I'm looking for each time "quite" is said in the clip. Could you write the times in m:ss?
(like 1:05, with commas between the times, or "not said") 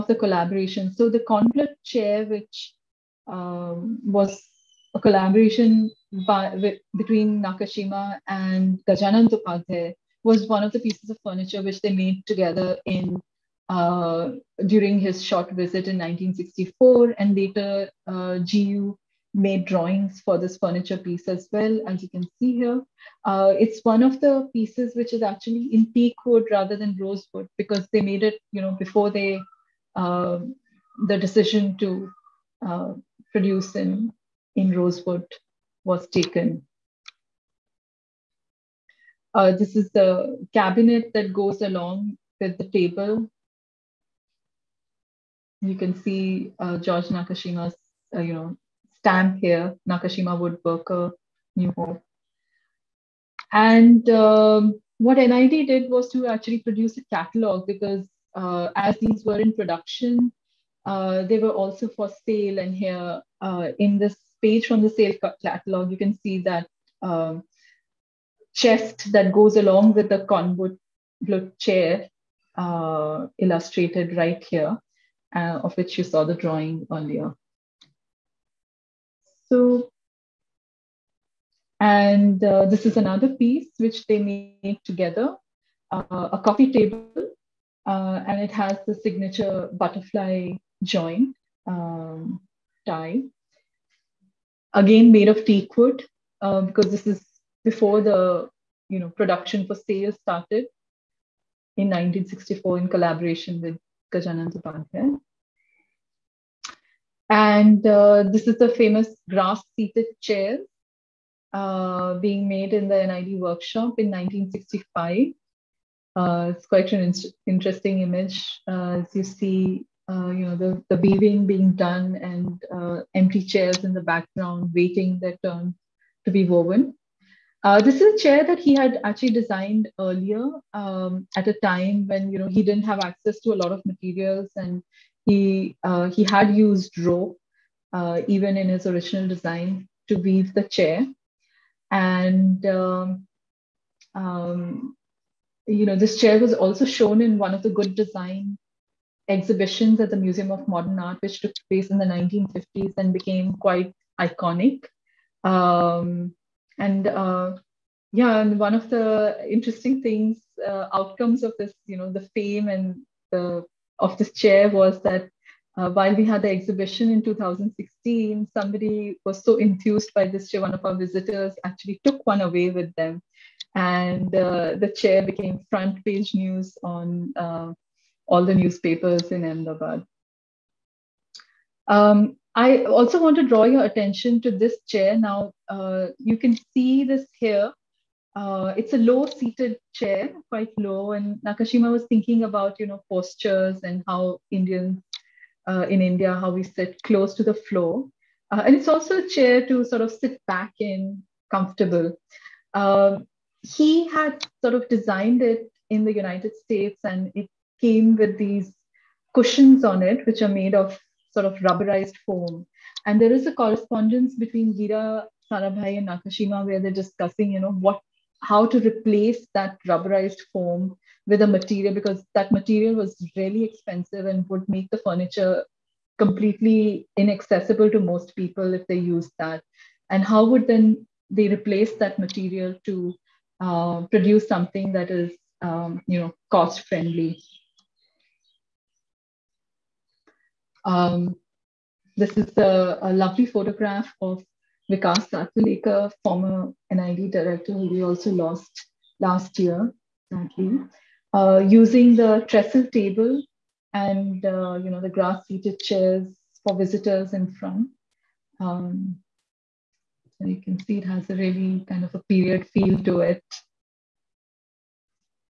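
1:56, 2:33, 3:10.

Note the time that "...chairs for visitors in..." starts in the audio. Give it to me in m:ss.
4:15.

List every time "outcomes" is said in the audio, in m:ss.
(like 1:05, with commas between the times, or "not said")
2:40.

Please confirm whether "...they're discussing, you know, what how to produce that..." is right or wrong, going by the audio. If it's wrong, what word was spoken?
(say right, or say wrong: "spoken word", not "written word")
wrong: "replace", not "produce".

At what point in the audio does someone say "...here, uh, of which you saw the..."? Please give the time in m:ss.
1:14.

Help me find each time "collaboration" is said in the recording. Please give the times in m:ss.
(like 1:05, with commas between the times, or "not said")
0:00, 0:04, 1:42.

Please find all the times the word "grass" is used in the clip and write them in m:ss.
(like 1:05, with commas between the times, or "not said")
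1:49, 4:15.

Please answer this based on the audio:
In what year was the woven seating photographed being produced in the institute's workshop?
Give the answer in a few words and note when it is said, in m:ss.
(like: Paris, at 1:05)
1965, at 1:54.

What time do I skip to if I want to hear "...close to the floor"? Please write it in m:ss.
3:17.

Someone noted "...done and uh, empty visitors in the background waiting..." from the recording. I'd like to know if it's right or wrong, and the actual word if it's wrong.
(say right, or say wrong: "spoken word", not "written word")
wrong: "chairs", not "visitors".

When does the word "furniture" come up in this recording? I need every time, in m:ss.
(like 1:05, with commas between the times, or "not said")
0:11, 0:20, 3:44.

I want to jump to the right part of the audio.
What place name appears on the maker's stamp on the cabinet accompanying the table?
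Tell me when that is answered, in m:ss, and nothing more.
0:51.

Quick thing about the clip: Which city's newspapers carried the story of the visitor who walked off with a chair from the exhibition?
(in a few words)
Ahmedabad.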